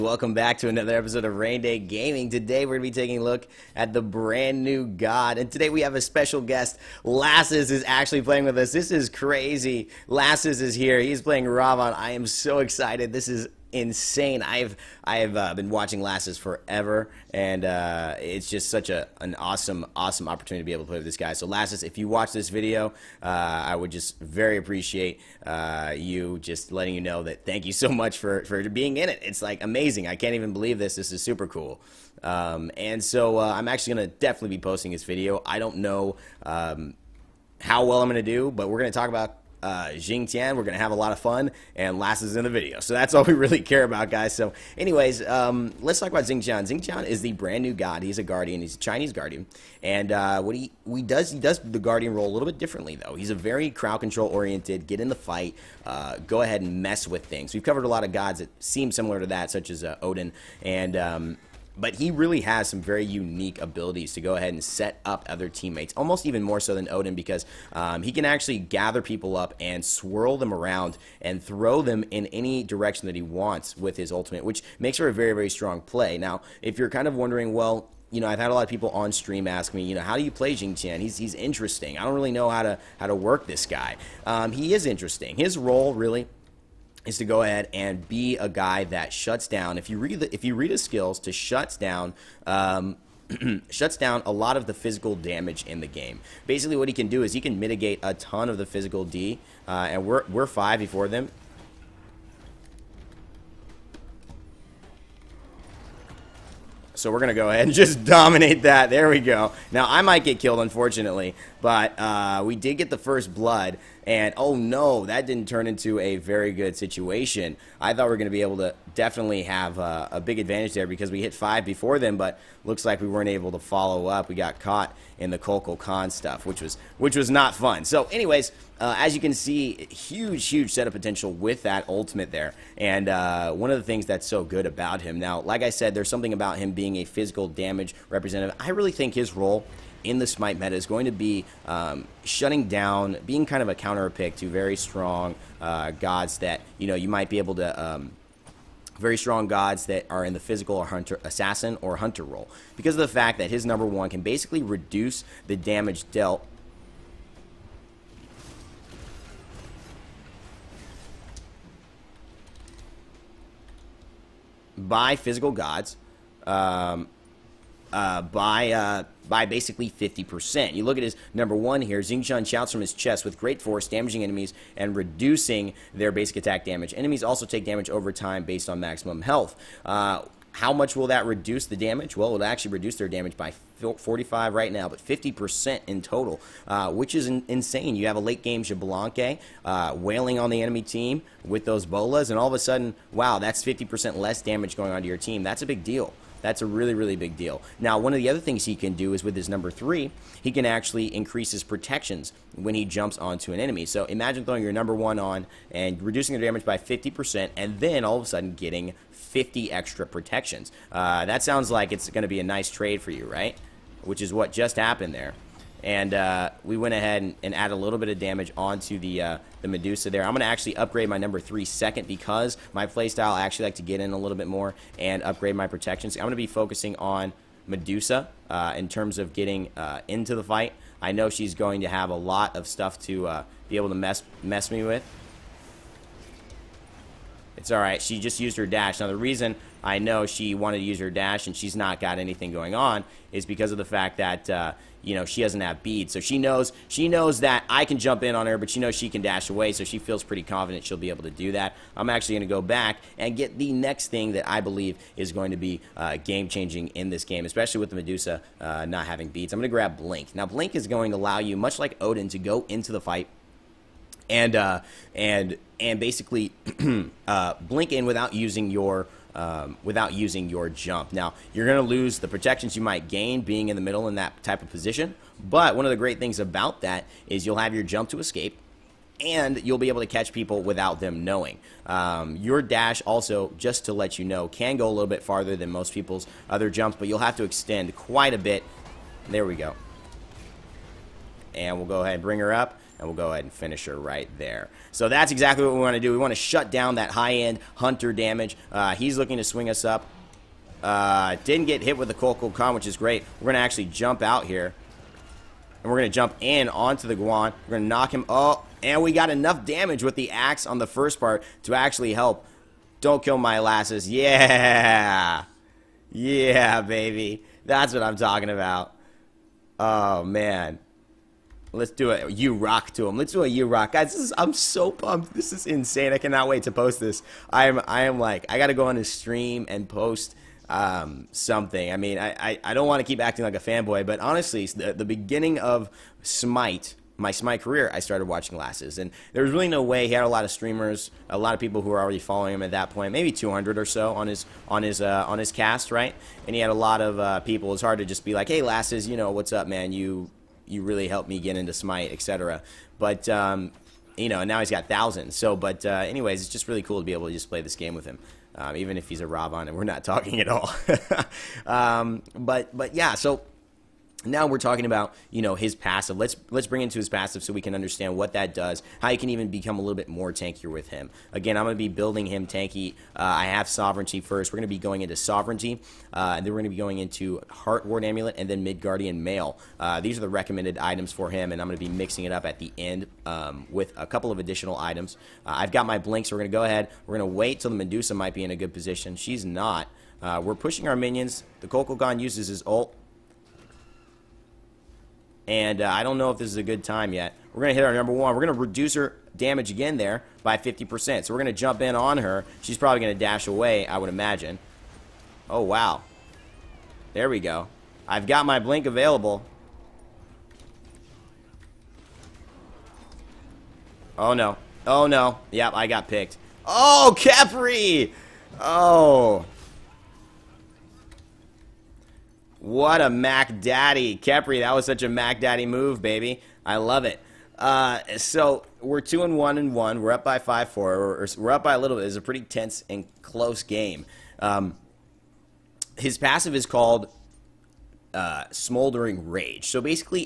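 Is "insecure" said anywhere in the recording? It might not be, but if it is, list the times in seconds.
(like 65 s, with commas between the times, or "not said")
not said.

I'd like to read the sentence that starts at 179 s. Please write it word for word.
Uh, how much will that reduce the damage?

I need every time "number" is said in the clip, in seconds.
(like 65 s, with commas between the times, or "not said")
153 s, 171 s, 199 s, 204 s, 221 s, 397 s.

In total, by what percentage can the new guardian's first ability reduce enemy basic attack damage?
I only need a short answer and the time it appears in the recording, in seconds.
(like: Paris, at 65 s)
50%, at 184 s.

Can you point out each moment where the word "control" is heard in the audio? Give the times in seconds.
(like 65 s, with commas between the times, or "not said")
53 s.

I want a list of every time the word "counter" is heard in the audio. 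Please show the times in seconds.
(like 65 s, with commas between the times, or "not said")
143 s.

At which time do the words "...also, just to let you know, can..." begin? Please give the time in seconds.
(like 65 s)
283 s.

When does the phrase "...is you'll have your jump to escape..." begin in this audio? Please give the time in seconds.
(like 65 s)
277 s.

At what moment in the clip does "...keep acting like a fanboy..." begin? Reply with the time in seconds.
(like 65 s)
333 s.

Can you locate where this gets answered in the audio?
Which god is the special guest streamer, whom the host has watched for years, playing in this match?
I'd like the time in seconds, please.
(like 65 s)
10 s.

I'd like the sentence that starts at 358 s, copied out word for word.
Um, even if he's a Robon and we're not talking at all.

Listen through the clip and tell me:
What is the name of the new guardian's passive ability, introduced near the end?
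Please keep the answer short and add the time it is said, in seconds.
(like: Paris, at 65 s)
Smoldering Rage, at 438 s.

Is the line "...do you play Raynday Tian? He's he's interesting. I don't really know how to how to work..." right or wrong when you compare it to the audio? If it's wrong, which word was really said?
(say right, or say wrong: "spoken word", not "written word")
wrong: "Xing", not "Raynday".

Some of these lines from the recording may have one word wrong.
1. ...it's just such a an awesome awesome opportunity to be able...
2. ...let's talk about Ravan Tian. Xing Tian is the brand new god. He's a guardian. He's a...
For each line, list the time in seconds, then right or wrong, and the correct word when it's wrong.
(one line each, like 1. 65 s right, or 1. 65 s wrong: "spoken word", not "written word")
1. 18 s right
2. 45 s wrong: "Xing", not "Ravan".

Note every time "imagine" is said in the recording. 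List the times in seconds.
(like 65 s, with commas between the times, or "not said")
204 s, 404 s.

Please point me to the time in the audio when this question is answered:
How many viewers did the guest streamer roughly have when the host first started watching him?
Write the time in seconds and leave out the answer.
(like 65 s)
343 s.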